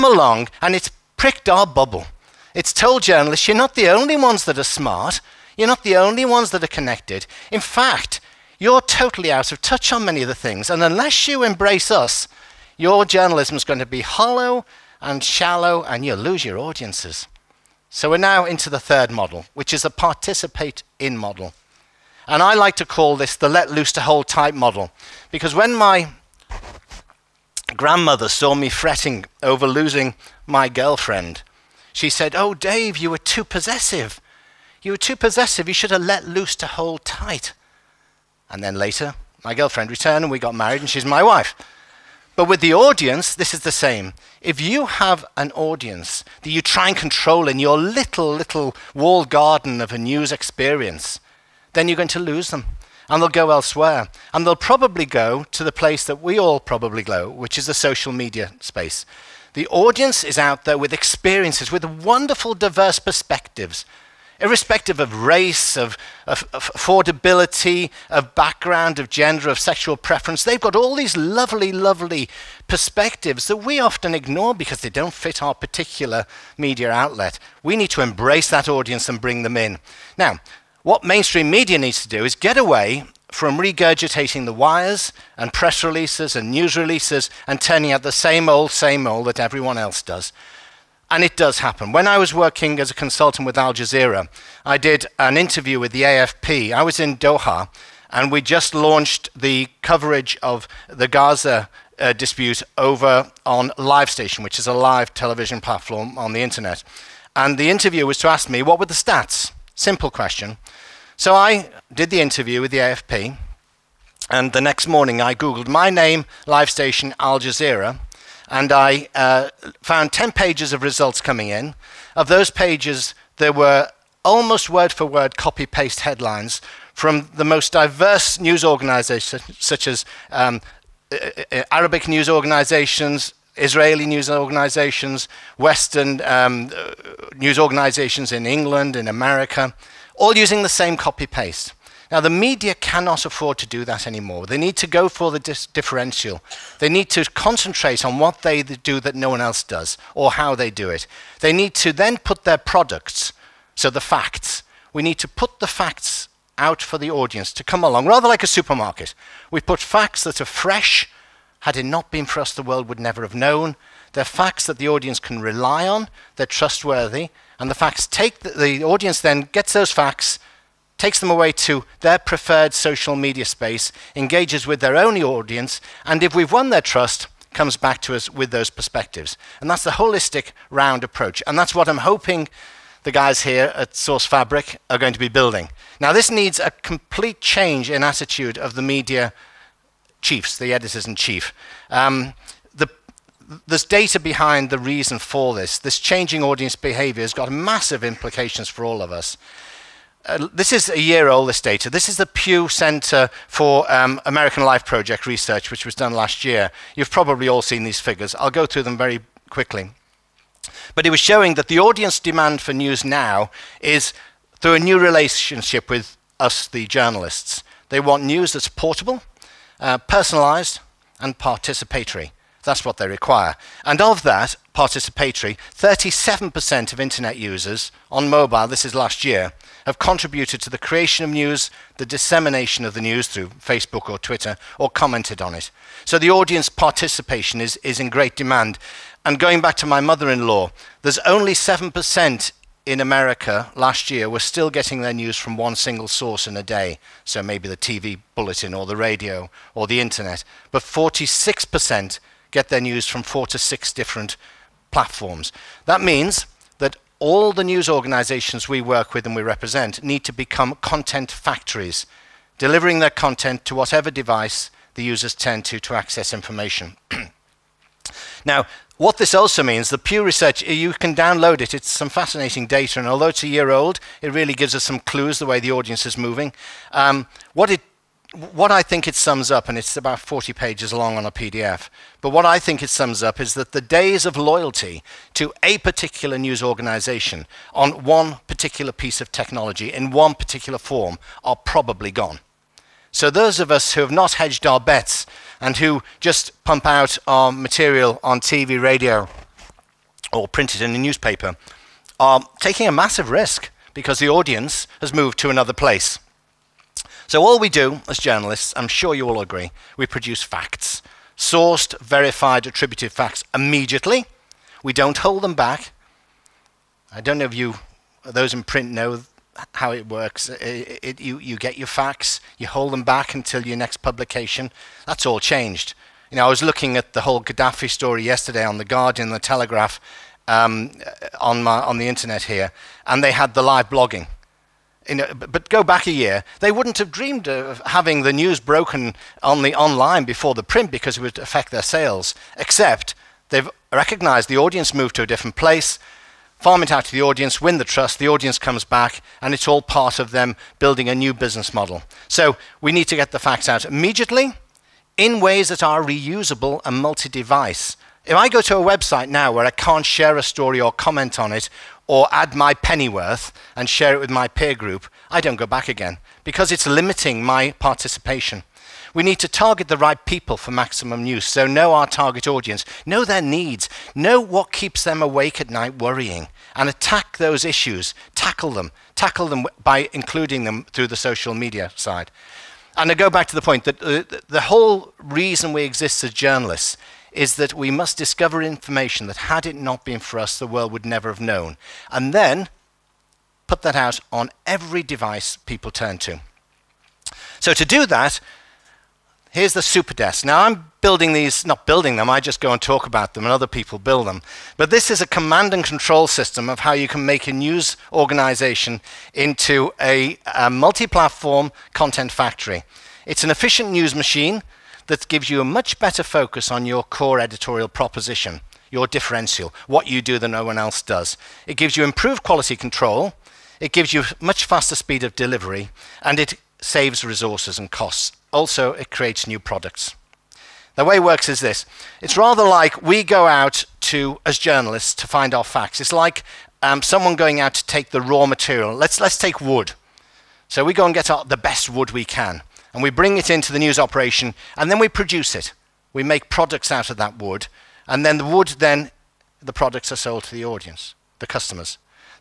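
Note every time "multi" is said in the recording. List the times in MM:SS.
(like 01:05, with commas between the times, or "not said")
05:56, 06:50.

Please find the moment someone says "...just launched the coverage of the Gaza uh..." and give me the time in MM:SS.
01:38.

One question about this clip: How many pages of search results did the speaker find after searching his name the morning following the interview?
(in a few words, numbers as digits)
10.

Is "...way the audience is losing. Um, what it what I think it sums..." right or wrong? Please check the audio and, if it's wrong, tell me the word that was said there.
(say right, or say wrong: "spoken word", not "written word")
wrong: "moving", not "losing".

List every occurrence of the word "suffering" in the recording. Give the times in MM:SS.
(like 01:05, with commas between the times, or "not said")
not said.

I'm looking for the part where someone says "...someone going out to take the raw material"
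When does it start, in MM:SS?
07:17.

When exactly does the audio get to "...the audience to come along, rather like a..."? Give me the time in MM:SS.
02:36.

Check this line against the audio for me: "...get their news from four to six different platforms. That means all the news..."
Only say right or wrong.
right.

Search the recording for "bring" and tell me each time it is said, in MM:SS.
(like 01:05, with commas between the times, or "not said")
01:19, 07:23.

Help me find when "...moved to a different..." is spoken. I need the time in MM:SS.
05:44.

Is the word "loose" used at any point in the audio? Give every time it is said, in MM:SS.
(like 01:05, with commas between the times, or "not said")
00:23, 00:36.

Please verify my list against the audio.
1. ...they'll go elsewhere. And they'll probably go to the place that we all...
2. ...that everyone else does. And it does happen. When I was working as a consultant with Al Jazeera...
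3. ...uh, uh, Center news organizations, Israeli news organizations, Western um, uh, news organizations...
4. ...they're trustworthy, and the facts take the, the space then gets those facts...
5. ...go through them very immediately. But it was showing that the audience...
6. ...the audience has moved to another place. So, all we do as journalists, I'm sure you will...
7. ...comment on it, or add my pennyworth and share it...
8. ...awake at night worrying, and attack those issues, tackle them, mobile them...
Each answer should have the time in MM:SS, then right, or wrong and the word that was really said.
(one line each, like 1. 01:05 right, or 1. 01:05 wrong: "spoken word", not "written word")
1. 00:53 right
2. 01:29 right
3. 02:11 wrong: "Arabic", not "Center"
4. 02:46 wrong: "audience", not "space"
5. 03:28 wrong: "quickly", not "immediately"
6. 05:04 right
7. 06:00 right
8. 06:15 wrong: "tackle", not "mobile".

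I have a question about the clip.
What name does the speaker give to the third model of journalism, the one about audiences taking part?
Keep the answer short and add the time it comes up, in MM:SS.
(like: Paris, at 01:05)
participate in model, at 00:19.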